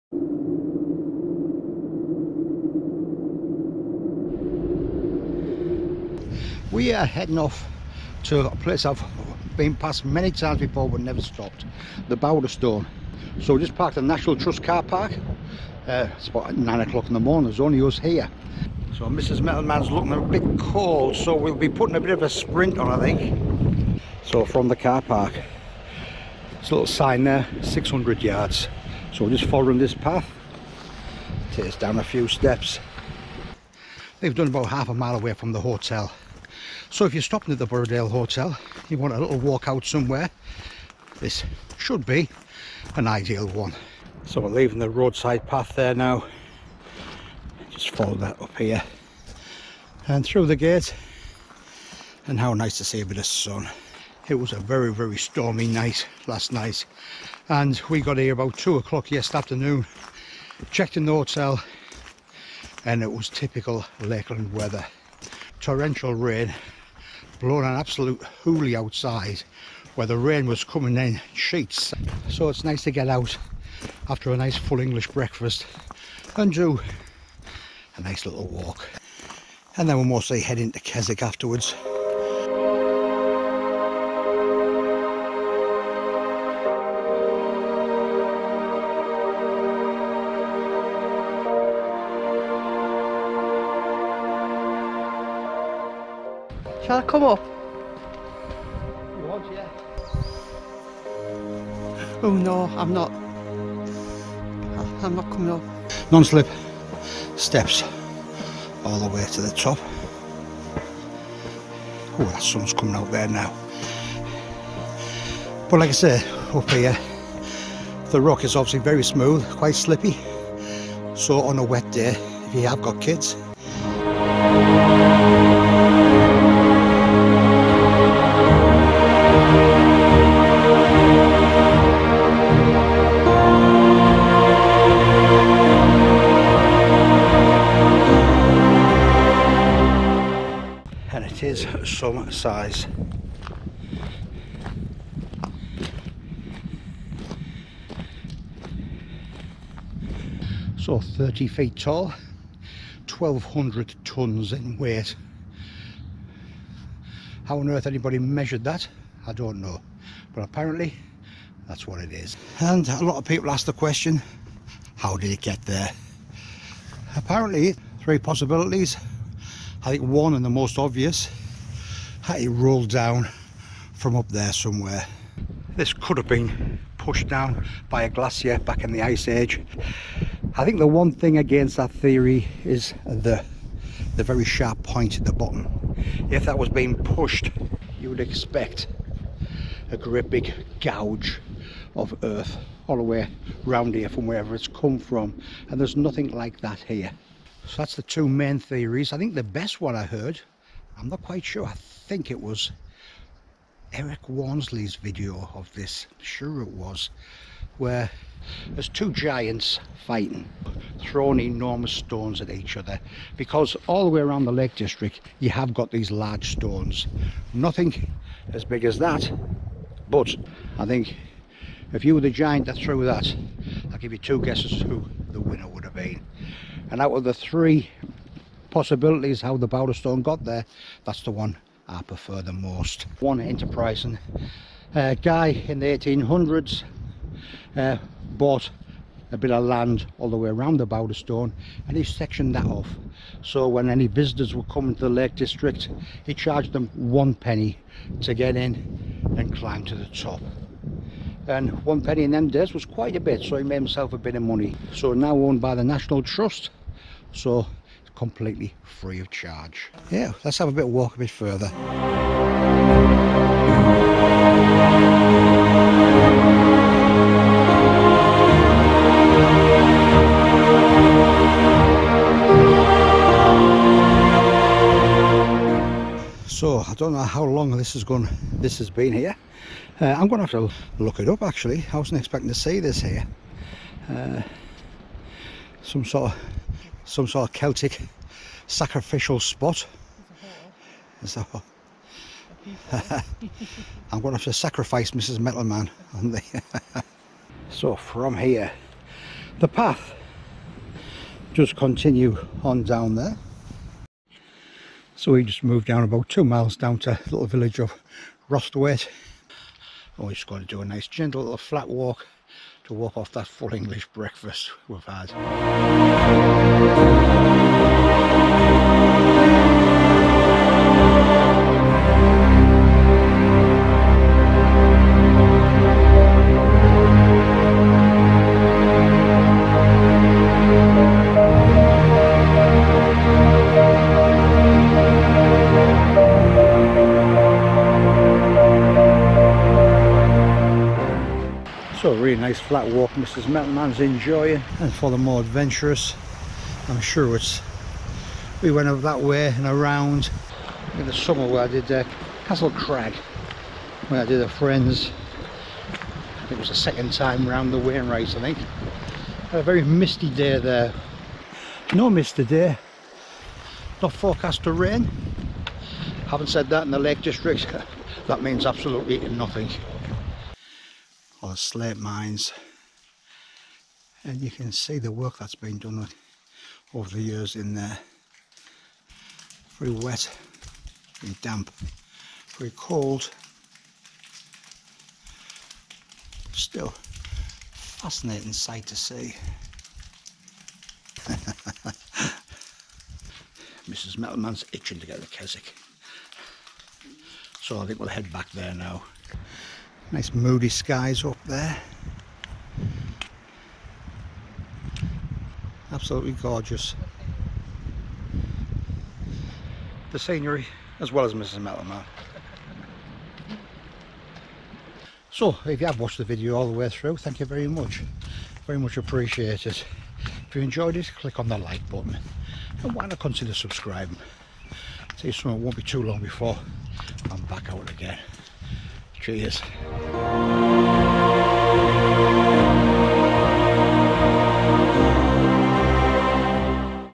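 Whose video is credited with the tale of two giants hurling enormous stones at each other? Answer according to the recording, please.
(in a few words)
Eric Warnsley.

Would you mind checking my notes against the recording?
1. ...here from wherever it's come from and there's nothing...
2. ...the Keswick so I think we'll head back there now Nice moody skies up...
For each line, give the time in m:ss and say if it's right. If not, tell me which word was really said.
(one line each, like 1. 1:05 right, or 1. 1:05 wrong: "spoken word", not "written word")
1. 3:13 right
2. 6:35 right.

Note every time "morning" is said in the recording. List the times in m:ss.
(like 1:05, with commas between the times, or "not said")
0:17.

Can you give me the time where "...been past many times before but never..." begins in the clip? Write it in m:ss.
0:09.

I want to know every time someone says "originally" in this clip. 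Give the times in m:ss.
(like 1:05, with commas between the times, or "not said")
not said.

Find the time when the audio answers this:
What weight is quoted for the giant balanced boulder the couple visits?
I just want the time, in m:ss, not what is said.
2:33.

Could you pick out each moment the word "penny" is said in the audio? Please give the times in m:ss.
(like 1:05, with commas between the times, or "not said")
4:07, 4:12.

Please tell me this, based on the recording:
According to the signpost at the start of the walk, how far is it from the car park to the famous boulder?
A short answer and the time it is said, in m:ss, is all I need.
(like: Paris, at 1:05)
600 yards, at 0:27.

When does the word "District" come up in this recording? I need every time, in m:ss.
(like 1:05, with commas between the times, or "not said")
3:34, 4:05, 6:07.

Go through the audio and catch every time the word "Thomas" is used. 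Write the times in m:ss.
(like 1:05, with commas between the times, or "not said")
not said.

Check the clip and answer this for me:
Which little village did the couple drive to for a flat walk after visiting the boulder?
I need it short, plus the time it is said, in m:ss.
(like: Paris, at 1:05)
Rosthwaite, at 5:08.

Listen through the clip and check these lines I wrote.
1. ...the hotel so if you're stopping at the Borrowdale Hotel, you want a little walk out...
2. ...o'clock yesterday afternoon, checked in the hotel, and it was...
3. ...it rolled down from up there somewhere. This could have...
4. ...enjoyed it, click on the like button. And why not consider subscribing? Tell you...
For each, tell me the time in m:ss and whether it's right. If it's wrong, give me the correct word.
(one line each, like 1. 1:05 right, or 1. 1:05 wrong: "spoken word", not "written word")
1. 0:35 right
2. 0:58 right
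3. 2:52 right
4. 7:00 right.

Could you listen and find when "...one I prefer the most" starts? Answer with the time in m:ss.
3:51.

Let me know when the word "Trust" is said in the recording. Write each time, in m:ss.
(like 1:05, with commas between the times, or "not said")
0:14, 4:16.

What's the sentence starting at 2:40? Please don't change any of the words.
But apparently, that's what it is.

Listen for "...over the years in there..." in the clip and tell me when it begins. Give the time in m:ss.
6:16.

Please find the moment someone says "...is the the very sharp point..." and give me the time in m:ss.
3:02.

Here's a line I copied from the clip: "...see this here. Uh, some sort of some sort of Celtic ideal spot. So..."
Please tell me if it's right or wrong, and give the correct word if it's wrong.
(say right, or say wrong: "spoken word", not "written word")
wrong: "sacrificial", not "ideal".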